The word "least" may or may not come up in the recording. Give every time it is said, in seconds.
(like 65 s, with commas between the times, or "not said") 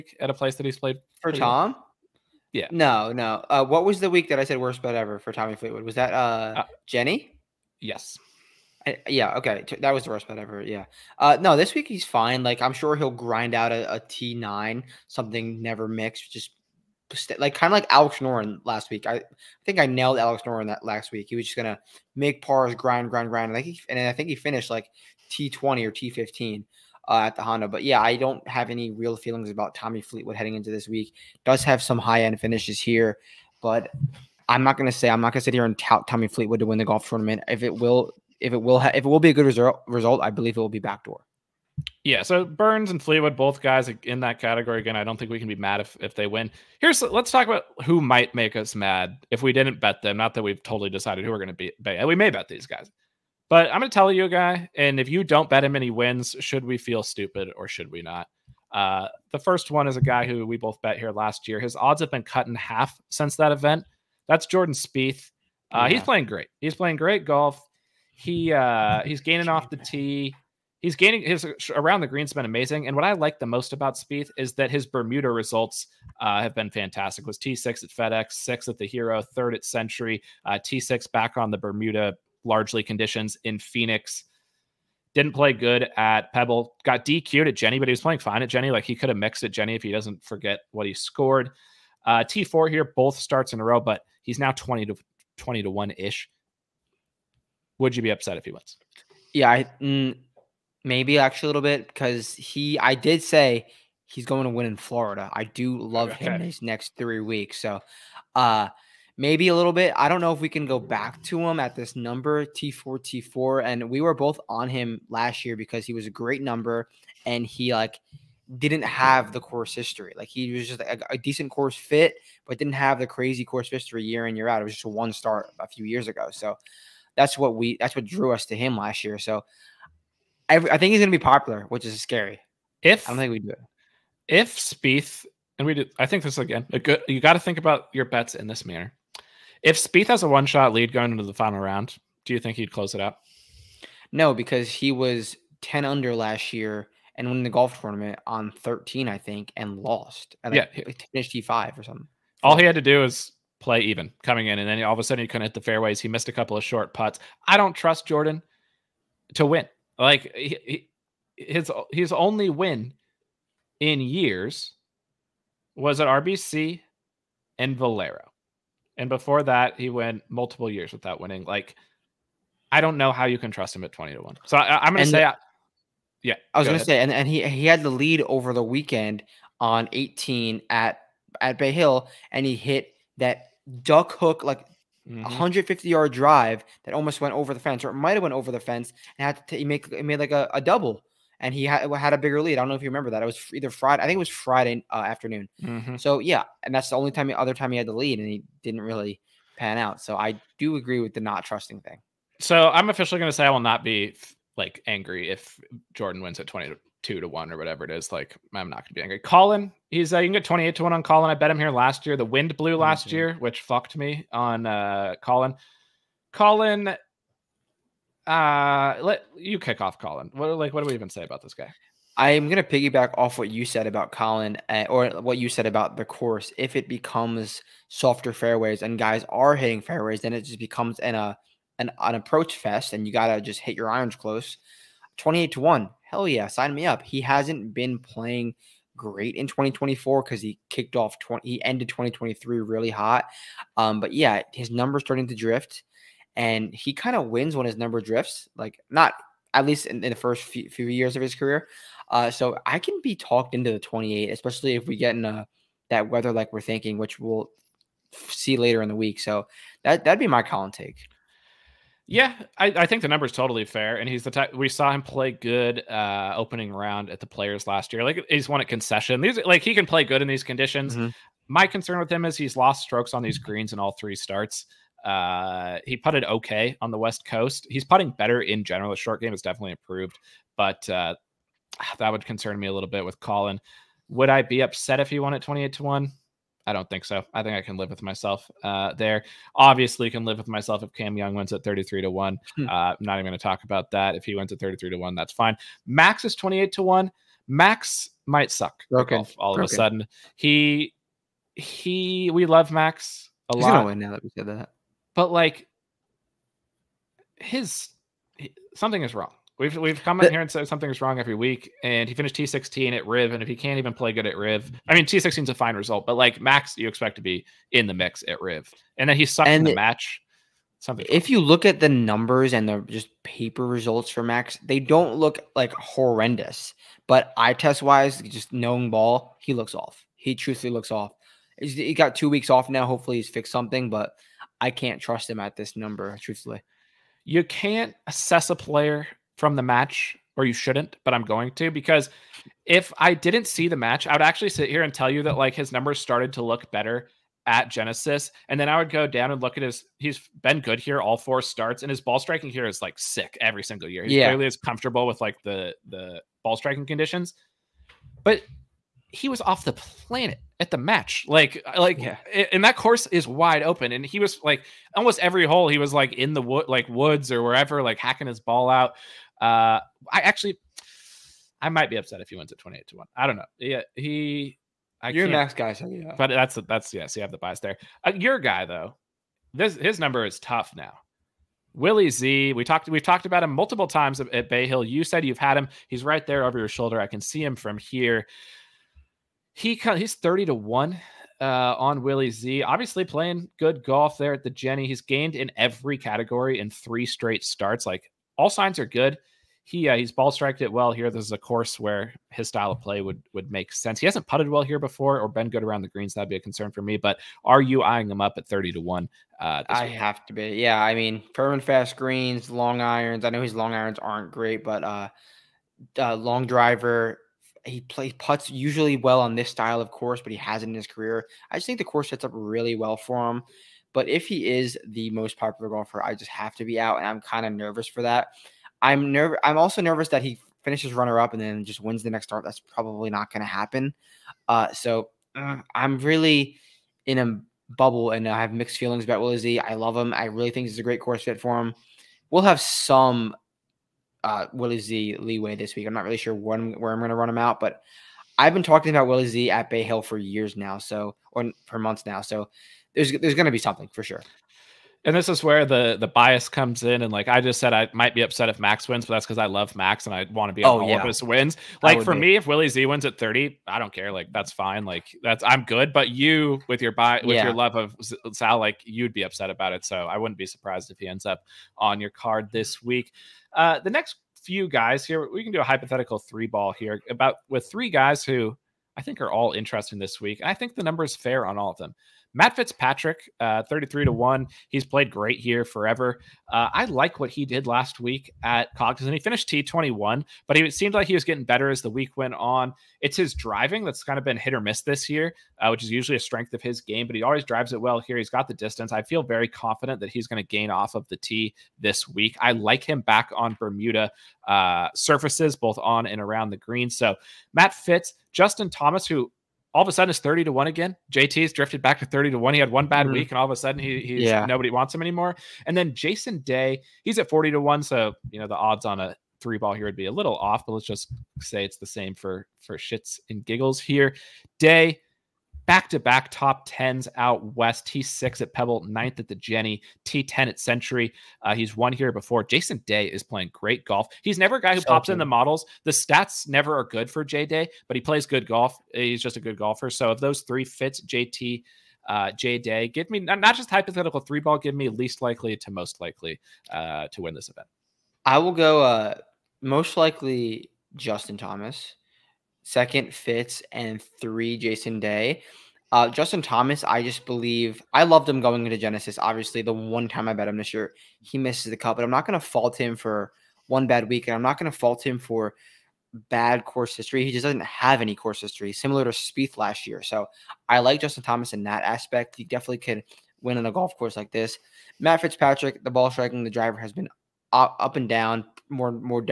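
249 s, 544 s.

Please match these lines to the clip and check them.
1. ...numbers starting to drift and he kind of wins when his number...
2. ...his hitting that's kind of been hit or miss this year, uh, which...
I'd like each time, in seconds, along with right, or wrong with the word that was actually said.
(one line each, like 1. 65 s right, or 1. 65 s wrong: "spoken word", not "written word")
1. 244 s right
2. 493 s wrong: "driving", not "hitting".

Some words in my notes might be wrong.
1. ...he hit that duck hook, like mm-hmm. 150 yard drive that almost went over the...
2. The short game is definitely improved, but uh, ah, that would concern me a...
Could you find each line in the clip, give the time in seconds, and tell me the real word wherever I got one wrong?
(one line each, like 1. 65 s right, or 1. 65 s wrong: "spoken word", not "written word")
1. 182 s right
2. 278 s right.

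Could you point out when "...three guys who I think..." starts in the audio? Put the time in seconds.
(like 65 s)
477 s.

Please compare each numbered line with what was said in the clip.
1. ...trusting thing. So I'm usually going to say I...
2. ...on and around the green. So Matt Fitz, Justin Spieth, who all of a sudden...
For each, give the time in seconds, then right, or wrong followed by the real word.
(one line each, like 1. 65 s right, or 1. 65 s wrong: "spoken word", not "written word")
1. 201 s wrong: "officially", not "usually"
2. 505 s wrong: "Thomas", not "Spieth".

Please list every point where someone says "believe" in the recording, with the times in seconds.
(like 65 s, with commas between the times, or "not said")
40 s, 557 s.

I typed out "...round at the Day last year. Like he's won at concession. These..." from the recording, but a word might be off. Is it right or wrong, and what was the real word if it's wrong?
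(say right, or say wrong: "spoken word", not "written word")
wrong: "Players", not "Day".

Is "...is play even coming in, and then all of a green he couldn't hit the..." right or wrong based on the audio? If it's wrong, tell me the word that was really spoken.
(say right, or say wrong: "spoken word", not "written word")
wrong: "sudden", not "green".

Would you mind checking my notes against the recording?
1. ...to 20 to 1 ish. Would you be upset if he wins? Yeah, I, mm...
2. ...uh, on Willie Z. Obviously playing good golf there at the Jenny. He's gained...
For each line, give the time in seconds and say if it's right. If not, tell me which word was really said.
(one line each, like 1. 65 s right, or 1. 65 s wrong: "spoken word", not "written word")
1. 94 s right
2. 391 s right.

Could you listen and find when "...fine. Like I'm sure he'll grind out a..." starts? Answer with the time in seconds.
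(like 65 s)
12 s.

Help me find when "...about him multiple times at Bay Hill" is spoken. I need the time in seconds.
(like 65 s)
383 s.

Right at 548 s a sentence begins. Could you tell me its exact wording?
I will go uh, most likely Justin Thomas second Fitz, and three Jason Day.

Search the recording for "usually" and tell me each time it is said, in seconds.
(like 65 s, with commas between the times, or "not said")
418 s, 495 s.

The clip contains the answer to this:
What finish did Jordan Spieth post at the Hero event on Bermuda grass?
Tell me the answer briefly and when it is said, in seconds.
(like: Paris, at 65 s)
6th, at 78 s.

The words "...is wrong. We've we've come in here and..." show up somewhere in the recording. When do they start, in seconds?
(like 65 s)
309 s.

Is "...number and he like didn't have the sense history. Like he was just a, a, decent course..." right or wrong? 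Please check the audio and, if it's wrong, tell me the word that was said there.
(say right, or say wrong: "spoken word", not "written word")
wrong: "course", not "sense".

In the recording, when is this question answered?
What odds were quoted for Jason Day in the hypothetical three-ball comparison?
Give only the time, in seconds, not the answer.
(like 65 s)
517 s.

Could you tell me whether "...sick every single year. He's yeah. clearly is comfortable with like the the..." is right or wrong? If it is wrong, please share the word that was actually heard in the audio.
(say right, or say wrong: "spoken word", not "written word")
right.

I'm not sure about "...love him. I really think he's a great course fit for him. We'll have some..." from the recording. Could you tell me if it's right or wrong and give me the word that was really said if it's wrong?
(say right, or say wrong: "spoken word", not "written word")
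right.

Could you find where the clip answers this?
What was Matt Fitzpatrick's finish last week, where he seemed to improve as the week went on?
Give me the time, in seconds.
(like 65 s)
489 s.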